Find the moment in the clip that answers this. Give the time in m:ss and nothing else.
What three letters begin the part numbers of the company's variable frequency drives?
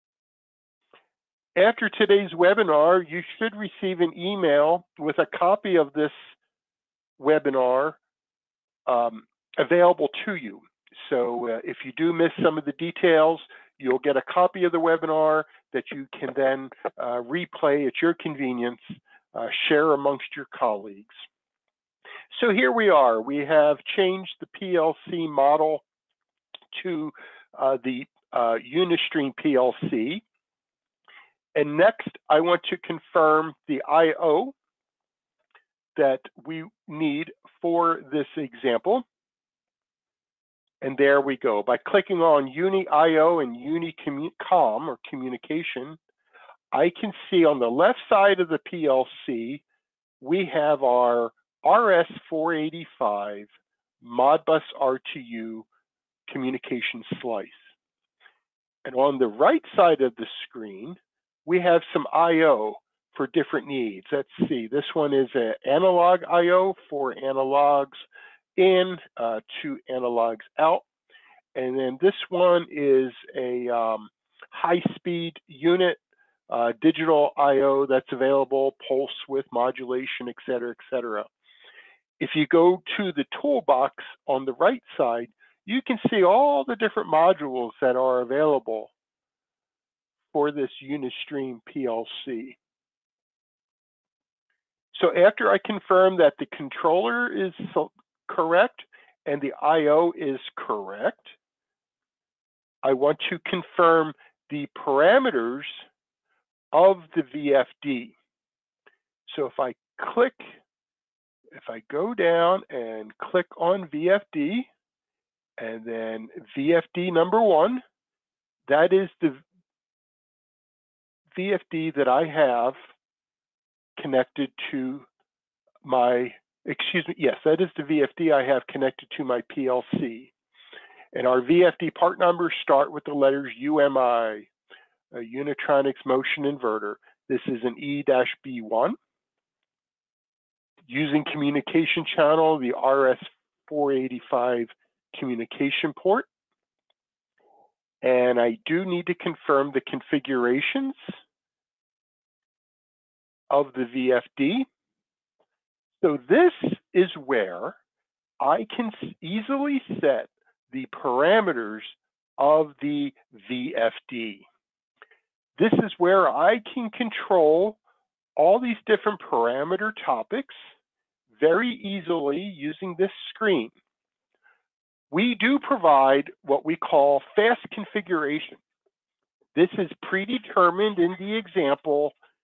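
2:13.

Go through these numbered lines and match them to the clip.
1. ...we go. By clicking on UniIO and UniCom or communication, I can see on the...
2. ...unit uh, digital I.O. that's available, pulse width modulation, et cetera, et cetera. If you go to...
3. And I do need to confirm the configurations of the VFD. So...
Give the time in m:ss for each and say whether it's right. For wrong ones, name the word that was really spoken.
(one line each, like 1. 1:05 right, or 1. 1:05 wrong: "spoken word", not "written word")
1. 0:41 right
2. 1:15 right
3. 2:28 right.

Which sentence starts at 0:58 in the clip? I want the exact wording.
And on the right side of the screen, we have some I.O.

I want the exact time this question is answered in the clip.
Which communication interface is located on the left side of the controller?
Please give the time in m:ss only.
0:51.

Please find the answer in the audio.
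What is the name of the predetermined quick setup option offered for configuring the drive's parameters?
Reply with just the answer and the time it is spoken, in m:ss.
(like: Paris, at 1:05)
fast configuration, at 2:57.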